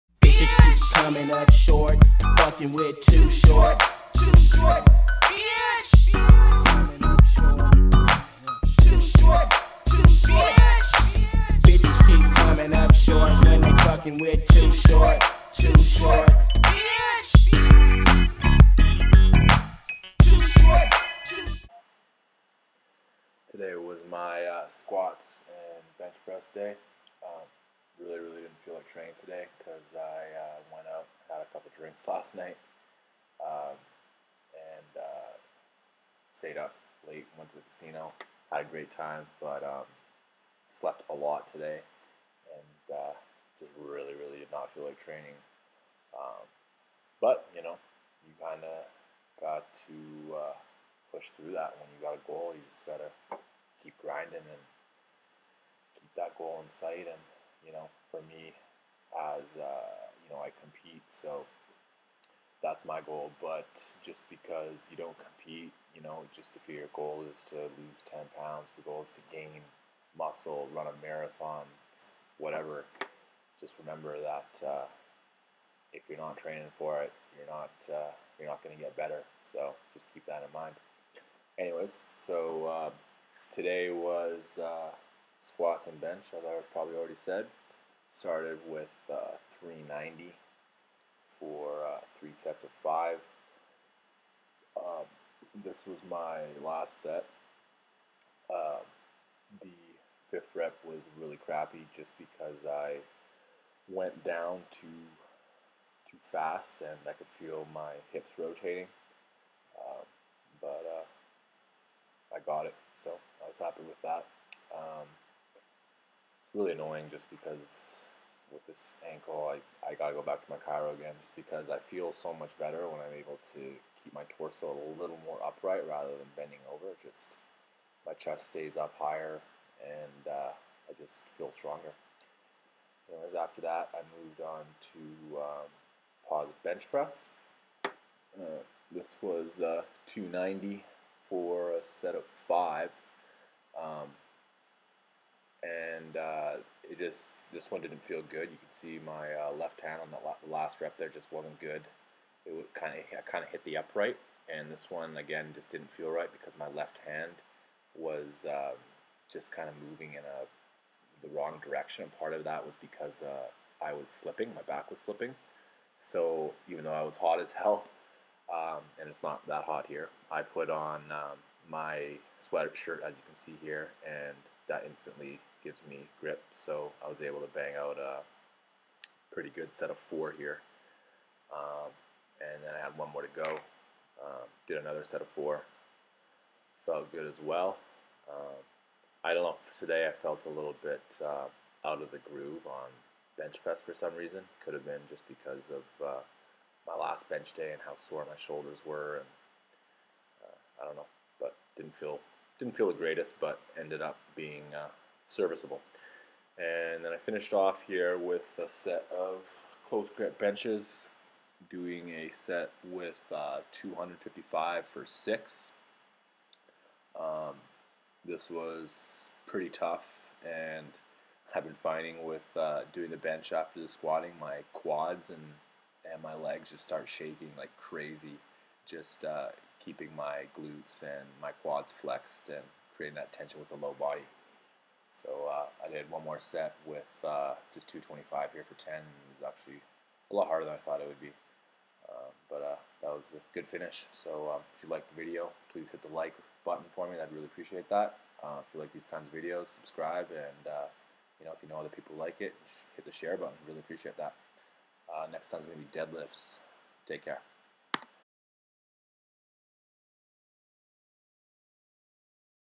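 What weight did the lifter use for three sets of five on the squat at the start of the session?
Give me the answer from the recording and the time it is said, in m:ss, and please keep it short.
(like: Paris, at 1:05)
390, at 1:29.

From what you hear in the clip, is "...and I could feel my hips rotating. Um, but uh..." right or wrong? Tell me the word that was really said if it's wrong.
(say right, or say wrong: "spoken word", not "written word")
right.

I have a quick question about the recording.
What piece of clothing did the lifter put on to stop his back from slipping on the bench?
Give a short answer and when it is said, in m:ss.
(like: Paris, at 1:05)
sweatshirt, at 2:52.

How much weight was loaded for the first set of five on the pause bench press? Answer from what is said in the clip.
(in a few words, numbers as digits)
290.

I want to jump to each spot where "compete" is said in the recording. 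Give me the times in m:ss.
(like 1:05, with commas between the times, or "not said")
1:00, 1:05.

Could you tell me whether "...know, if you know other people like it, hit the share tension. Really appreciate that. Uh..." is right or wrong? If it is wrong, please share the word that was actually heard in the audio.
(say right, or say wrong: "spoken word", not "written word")
wrong: "button", not "tension".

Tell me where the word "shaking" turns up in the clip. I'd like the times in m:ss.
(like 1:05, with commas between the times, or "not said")
3:47.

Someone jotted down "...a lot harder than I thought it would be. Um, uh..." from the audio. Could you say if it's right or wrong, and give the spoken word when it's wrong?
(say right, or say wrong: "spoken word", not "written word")
right.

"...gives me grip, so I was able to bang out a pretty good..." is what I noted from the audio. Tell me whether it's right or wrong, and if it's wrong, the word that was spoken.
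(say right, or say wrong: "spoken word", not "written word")
right.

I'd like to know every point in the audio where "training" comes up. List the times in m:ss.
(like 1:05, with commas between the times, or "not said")
0:28, 0:45, 1:16.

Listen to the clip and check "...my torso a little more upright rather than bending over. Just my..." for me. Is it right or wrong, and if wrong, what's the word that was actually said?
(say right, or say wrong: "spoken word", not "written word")
right.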